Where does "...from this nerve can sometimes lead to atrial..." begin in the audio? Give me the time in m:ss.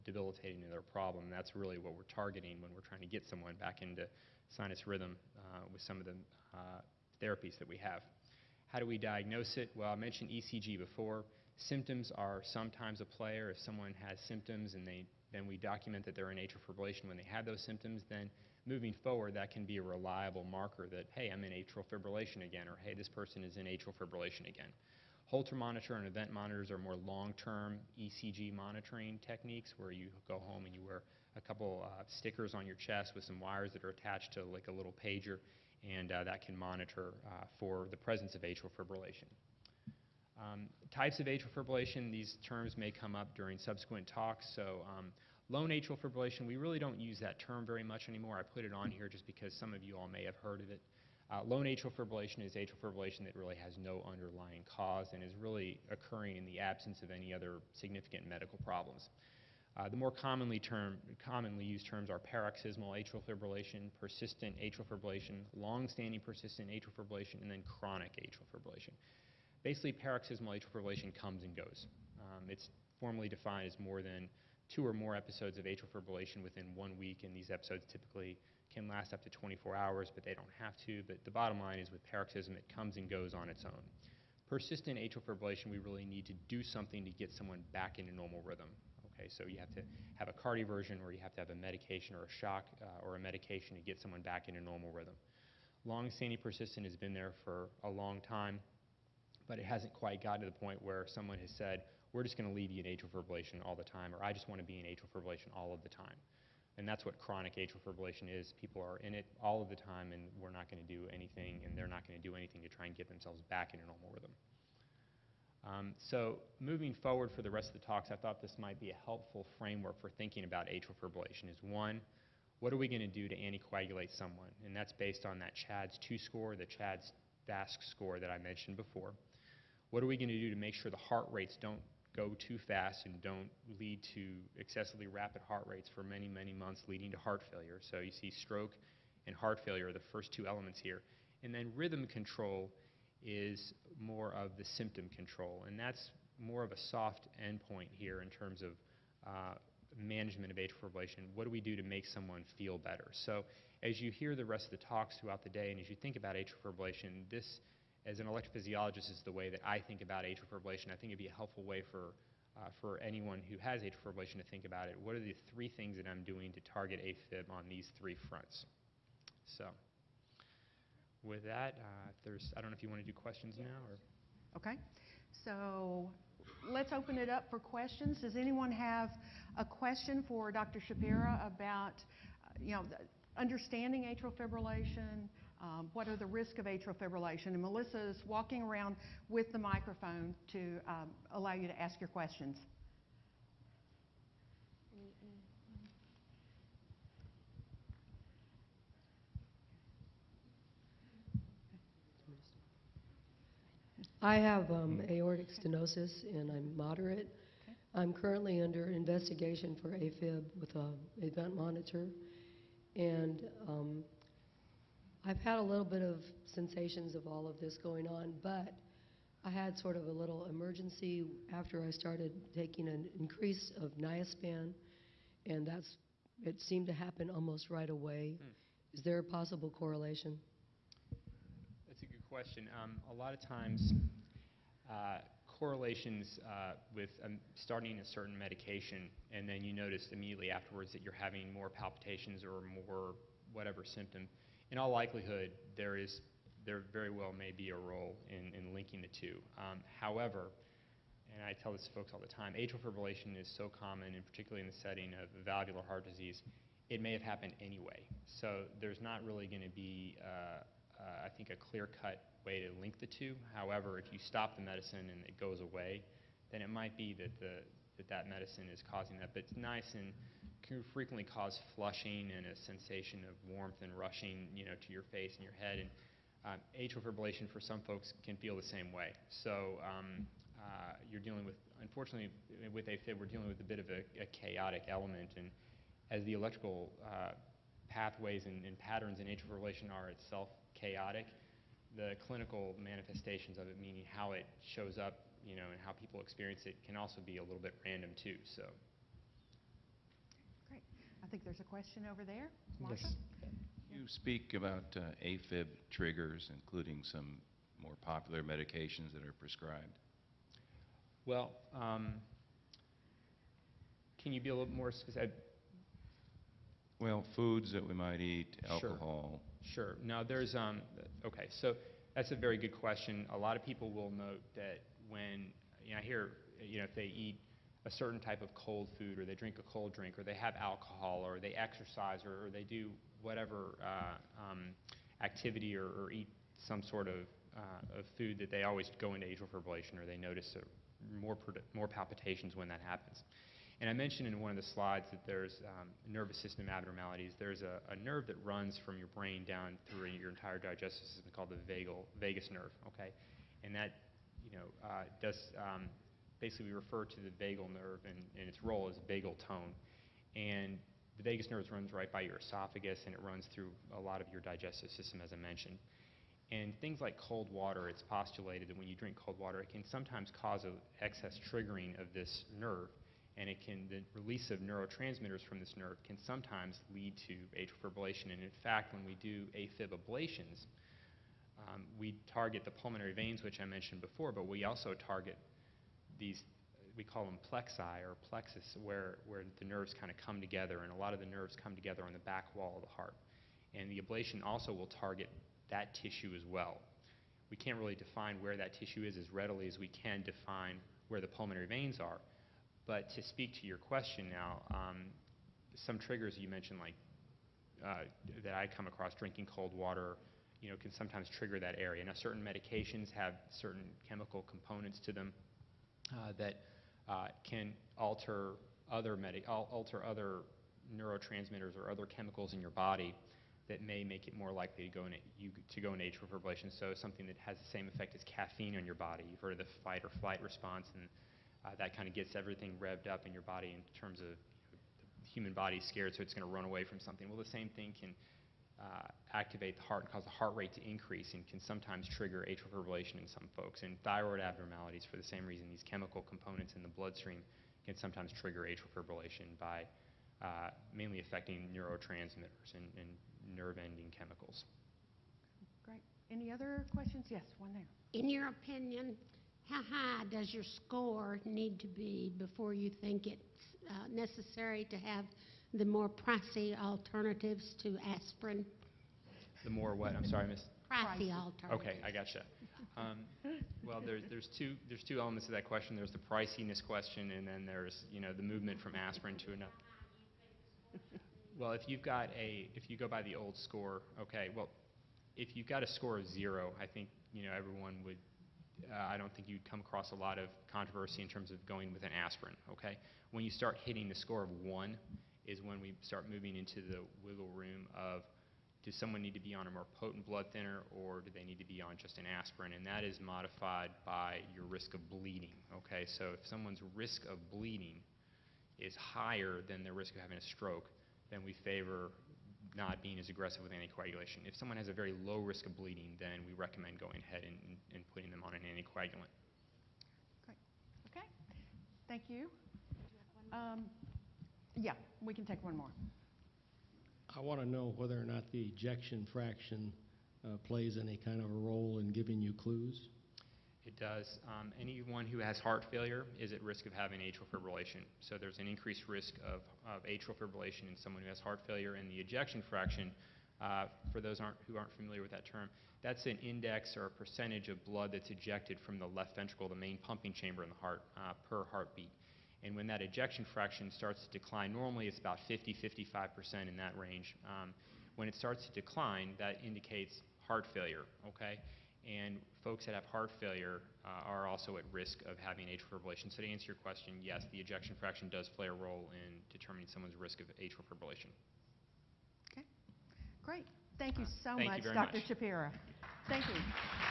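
6:15.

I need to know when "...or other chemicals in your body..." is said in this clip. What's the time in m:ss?
7:01.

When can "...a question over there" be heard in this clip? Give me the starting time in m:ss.
5:01.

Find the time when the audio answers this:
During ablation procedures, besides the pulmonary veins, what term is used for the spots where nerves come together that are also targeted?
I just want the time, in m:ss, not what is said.
6:28.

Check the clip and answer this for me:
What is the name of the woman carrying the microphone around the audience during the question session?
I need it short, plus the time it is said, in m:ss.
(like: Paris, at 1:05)
Melissa, at 3:07.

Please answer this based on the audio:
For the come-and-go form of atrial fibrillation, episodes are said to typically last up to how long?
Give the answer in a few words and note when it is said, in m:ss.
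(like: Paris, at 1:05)
24 hours, at 1:19.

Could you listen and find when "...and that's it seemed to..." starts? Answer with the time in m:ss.
3:45.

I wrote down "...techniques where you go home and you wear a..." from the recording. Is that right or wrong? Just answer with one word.
right.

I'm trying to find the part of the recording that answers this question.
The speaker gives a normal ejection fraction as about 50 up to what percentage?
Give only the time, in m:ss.
9:15.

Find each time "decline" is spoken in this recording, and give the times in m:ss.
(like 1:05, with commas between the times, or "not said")
9:14, 9:18.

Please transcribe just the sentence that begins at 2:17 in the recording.
So you see stroke and heart failure are the first two elements here.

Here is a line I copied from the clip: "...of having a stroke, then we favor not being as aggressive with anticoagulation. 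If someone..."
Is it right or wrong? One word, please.
right.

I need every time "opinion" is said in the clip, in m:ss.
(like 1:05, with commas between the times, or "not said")
7:38.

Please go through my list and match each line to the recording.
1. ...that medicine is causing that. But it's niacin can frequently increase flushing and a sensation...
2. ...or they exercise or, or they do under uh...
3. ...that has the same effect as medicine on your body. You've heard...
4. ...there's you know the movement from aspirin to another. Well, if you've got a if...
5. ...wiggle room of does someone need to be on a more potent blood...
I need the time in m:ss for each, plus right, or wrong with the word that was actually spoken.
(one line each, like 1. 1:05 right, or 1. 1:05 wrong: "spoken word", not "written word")
1. 4:28 wrong: "cause", not "increase"
2. 5:31 wrong: "whatever", not "under"
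3. 7:07 wrong: "caffeine", not "medicine"
4. 7:57 right
5. 8:17 right.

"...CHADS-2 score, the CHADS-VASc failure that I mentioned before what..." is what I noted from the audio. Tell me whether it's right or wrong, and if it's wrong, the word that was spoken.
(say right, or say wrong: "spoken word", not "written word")
wrong: "score", not "failure".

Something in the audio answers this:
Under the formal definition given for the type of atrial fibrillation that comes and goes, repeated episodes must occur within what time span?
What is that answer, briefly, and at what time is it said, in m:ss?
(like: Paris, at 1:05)
one week, at 1:16.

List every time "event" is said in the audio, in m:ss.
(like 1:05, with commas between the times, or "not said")
0:26, 3:31.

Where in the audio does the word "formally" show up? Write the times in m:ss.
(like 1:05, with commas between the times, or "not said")
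1:12.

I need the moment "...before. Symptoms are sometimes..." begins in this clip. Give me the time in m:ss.
0:10.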